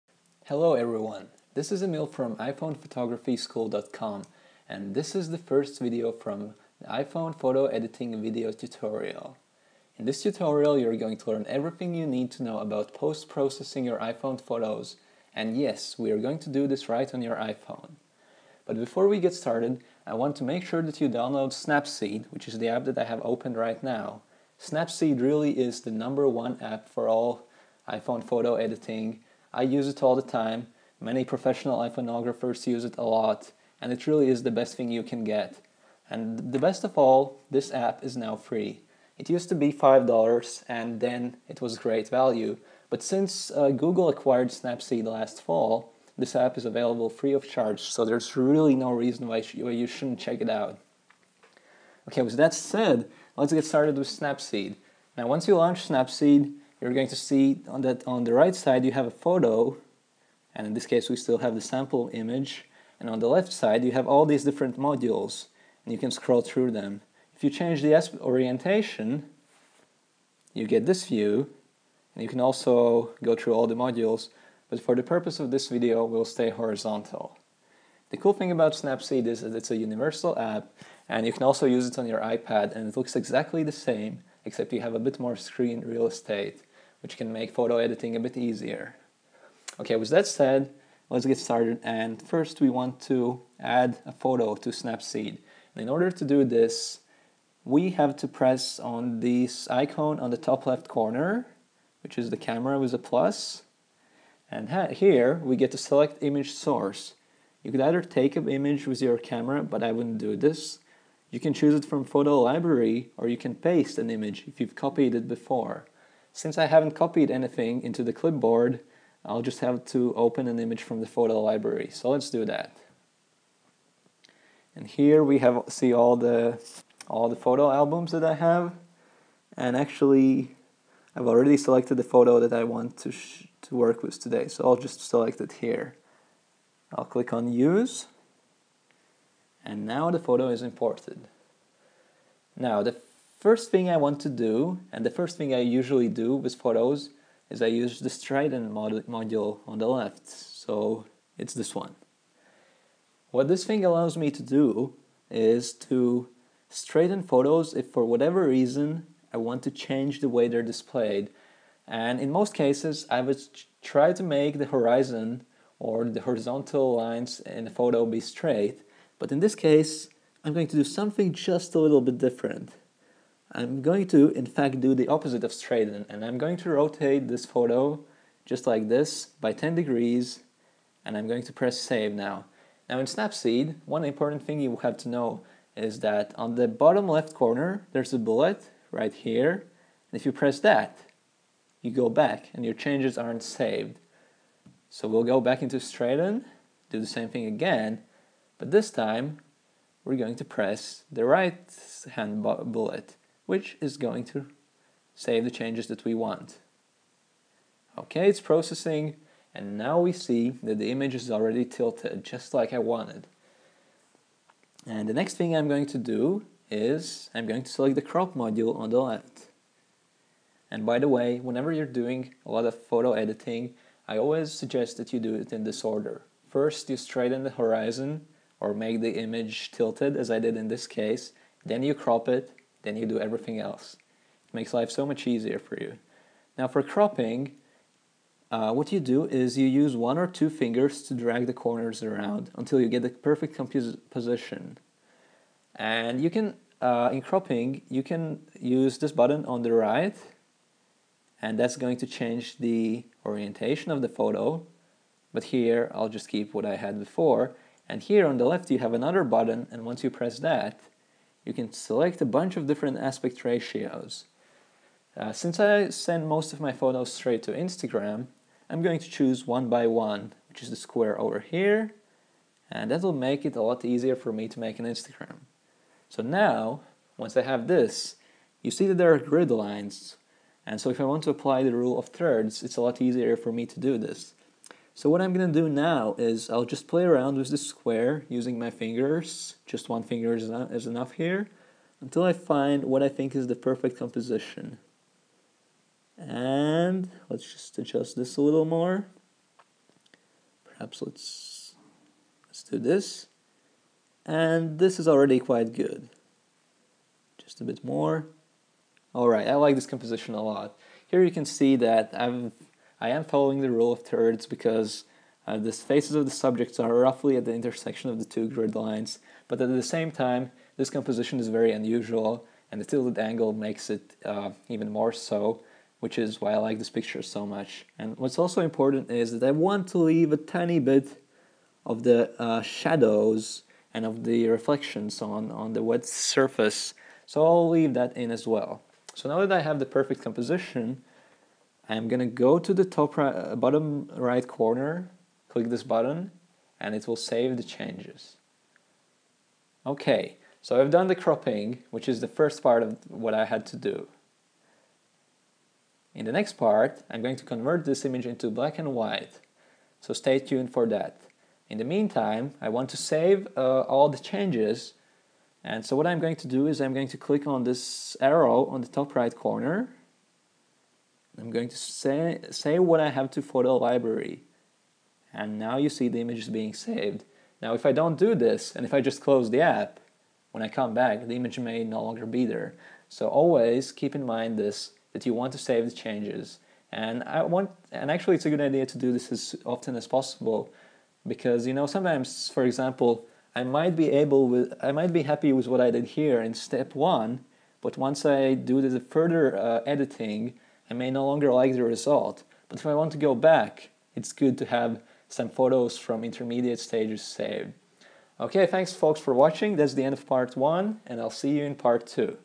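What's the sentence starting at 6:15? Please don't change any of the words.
And now you see the image is being saved.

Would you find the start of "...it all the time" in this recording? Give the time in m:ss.
0:29.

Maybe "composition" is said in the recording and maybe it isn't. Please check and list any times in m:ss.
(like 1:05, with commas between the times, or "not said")
4:53, 5:09, 5:20, 5:40.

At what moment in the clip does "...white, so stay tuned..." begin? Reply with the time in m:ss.
5:58.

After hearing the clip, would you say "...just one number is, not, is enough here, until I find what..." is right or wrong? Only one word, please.
wrong.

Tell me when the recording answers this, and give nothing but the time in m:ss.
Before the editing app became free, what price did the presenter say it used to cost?
0:39.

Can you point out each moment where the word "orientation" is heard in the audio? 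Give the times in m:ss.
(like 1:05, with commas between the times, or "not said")
1:08, 4:13.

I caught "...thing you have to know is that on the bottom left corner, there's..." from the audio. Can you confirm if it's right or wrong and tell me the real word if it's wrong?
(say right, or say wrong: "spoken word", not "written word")
right.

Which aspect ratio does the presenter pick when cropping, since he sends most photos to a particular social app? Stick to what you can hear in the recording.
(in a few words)
1:1 (square).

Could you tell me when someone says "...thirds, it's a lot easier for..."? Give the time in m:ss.
4:42.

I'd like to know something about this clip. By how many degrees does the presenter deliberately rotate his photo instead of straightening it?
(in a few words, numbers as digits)
10.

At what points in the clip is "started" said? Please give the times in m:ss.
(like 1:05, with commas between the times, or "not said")
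0:19, 0:53, 1:31.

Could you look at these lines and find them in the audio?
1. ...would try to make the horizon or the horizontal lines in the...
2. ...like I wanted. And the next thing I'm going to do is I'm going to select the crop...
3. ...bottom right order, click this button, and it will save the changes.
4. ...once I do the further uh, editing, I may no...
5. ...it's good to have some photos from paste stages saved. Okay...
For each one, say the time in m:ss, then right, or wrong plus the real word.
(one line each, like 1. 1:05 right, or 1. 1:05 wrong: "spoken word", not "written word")
1. 2:43 right
2. 3:32 right
3. 5:43 wrong: "corner", not "order"
4. 6:37 right
5. 6:44 wrong: "intermediate", not "paste".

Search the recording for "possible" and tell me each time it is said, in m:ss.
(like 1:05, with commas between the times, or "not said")
6:30.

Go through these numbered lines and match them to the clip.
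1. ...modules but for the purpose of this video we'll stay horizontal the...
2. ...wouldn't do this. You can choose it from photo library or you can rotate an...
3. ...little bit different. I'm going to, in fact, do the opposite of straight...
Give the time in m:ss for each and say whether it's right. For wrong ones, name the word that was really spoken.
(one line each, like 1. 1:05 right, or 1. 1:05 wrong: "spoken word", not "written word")
1. 1:13 right
2. 1:49 wrong: "paste", not "rotate"
3. 2:51 right.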